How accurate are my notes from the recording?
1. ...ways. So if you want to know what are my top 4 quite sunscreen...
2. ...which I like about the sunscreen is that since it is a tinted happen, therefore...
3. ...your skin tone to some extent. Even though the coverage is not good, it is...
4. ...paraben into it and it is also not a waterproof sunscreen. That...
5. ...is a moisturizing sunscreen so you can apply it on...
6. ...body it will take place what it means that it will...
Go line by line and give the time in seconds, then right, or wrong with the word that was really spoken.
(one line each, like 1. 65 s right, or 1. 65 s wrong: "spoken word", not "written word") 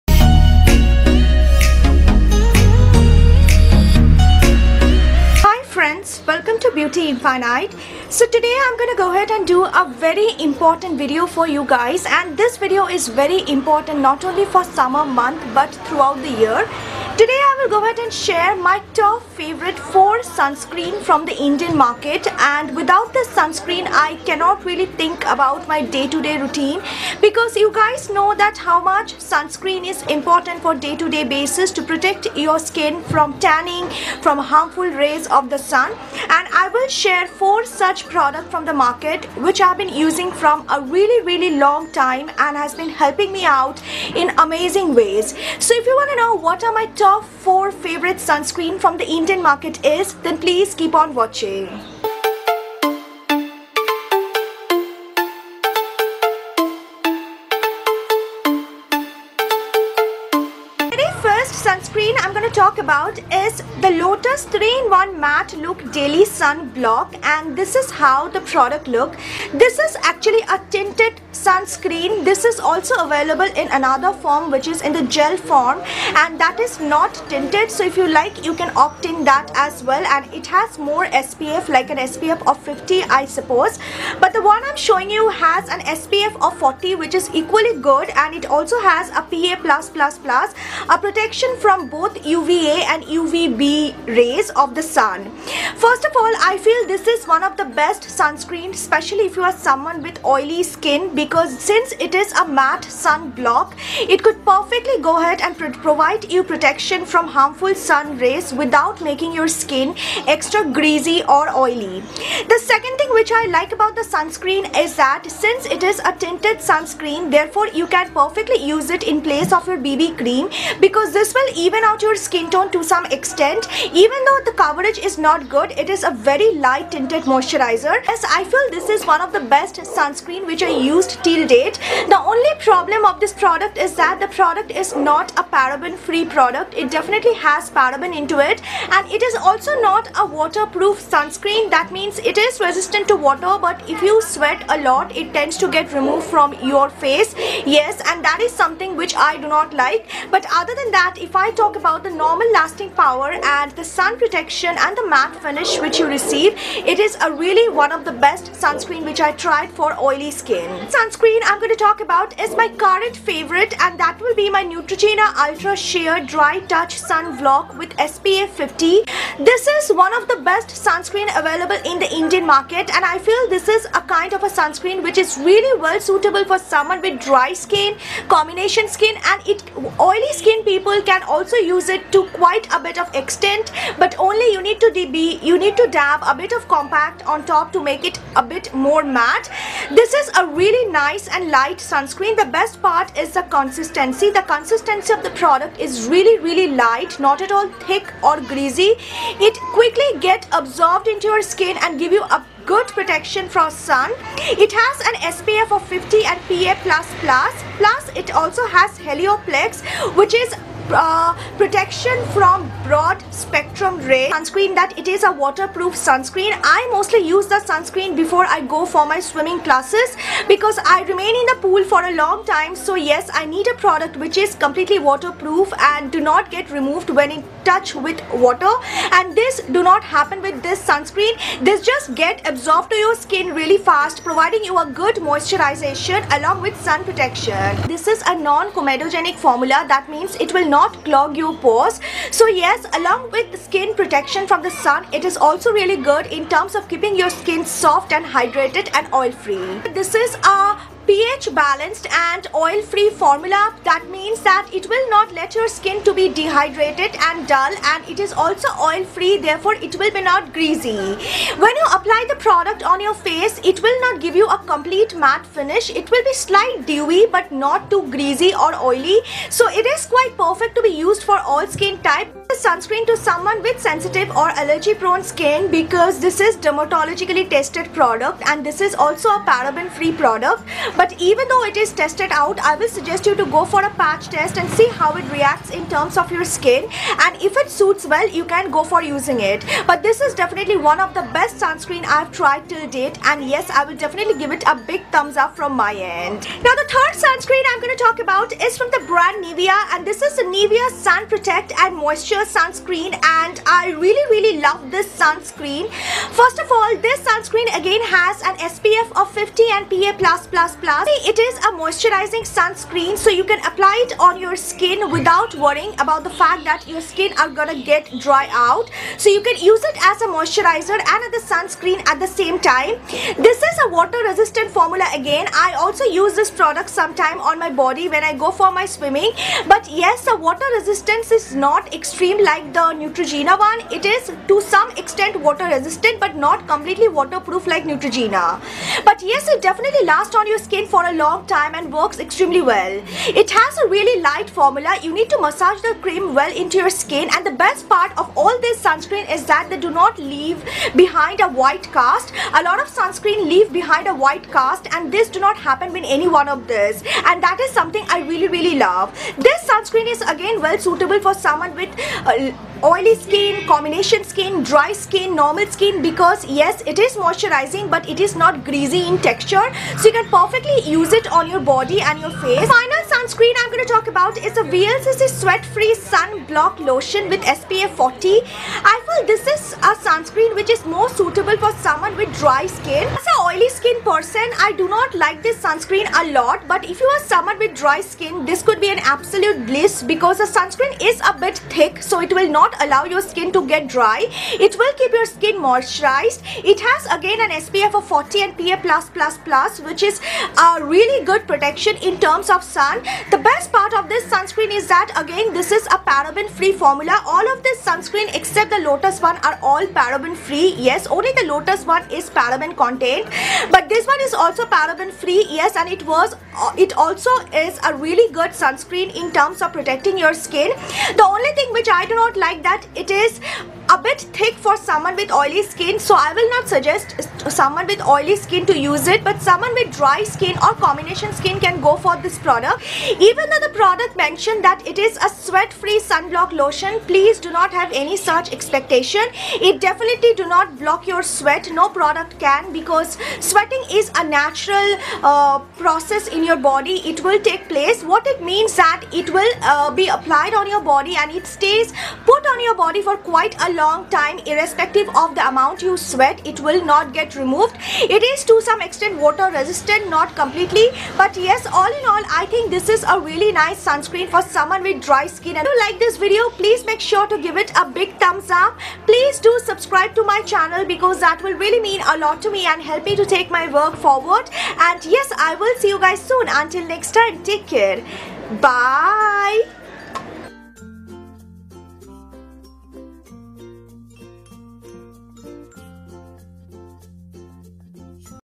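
1. 45 s wrong: "favorite", not "quite"
2. 113 s wrong: "sunscreen", not "happen"
3. 122 s right
4. 137 s right
5. 311 s right
6. 446 s right.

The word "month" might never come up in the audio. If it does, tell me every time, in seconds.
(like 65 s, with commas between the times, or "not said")
15 s.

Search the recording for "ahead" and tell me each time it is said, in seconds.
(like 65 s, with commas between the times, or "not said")
9 s, 17 s, 105 s.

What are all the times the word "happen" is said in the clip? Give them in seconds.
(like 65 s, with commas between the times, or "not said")
230 s, 355 s.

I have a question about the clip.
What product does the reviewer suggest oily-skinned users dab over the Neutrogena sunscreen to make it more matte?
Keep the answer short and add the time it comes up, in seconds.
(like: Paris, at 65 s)
compact, at 186 s.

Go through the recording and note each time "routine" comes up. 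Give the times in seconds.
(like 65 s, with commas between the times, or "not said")
26 s.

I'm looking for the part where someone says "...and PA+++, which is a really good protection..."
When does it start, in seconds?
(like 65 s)
398 s.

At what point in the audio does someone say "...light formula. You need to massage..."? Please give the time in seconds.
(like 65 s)
344 s.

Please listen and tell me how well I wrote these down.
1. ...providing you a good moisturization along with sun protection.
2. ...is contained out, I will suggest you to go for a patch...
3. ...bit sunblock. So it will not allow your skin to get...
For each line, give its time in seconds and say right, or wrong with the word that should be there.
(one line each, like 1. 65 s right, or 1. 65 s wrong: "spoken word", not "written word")
1. 234 s right
2. 281 s wrong: "tested", not "contained"
3. 391 s wrong: "thick", not "sunblock".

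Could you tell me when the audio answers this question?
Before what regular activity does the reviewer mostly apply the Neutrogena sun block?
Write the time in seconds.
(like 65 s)
219 s.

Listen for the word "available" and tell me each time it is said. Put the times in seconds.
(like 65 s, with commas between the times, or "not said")
73 s, 171 s.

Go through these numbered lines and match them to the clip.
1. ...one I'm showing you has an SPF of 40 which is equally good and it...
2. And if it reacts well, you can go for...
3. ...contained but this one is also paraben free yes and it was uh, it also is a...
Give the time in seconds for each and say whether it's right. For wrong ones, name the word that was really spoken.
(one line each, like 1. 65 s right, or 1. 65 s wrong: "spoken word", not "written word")
1. 84 s right
2. 287 s wrong: "suits", not "reacts"
3. 412 s right.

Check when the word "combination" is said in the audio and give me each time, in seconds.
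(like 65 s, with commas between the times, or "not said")
178 s, 363 s, 430 s.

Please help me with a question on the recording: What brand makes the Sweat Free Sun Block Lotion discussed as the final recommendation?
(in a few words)
VLCC.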